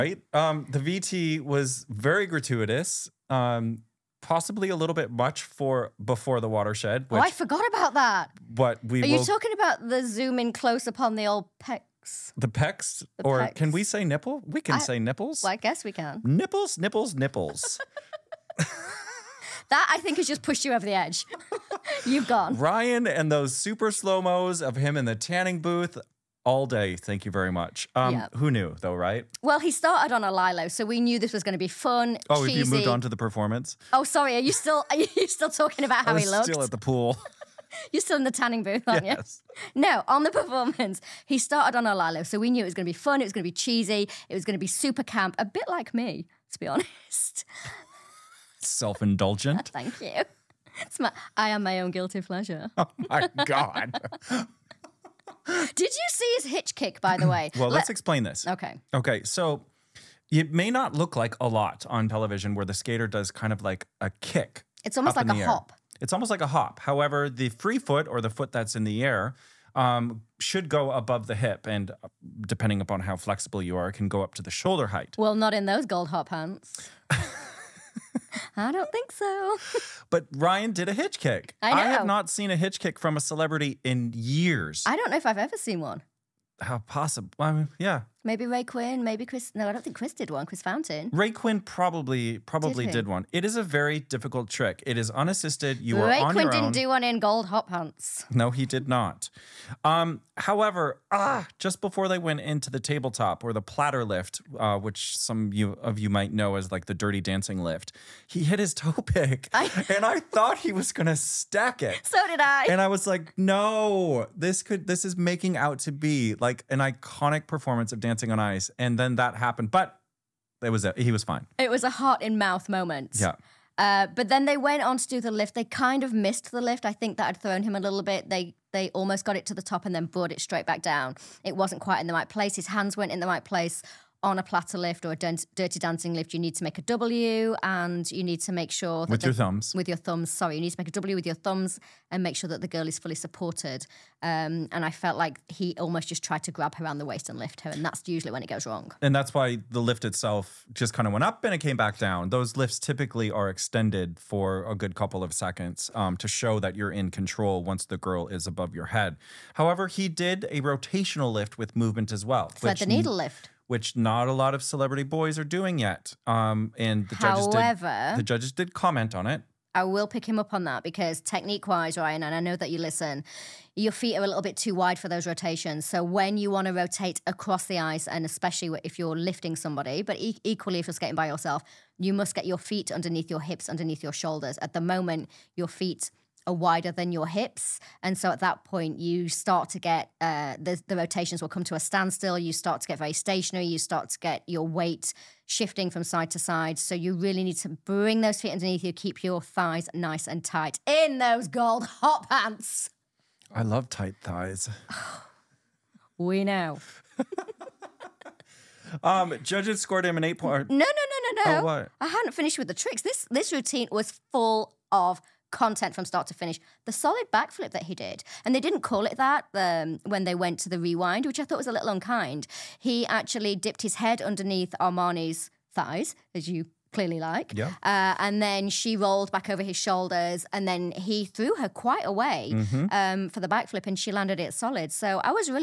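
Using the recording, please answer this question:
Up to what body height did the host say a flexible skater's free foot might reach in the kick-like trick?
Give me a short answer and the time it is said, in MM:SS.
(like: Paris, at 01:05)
Shoulder height, at 01:14.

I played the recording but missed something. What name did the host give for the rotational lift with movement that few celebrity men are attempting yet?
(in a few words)
Thread the needle.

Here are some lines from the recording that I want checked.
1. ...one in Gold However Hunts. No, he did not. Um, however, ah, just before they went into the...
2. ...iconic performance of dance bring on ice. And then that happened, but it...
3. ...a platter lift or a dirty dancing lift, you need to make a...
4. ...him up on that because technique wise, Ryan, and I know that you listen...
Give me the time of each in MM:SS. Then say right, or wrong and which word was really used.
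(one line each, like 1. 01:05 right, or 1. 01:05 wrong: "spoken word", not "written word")
1. 01:36 wrong: "Hop", not "However"
2. 01:56 wrong: "dancing", not "bring"
3. 02:14 right
4. 02:50 right.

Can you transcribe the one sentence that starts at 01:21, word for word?
I have not seen a hitch kick from a celebrity in years.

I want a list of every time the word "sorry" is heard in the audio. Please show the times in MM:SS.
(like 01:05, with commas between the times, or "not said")
00:34, 02:20.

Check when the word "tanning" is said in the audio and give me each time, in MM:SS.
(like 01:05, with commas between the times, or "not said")
00:25, 00:38.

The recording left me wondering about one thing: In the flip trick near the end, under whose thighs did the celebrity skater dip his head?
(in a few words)
Amani.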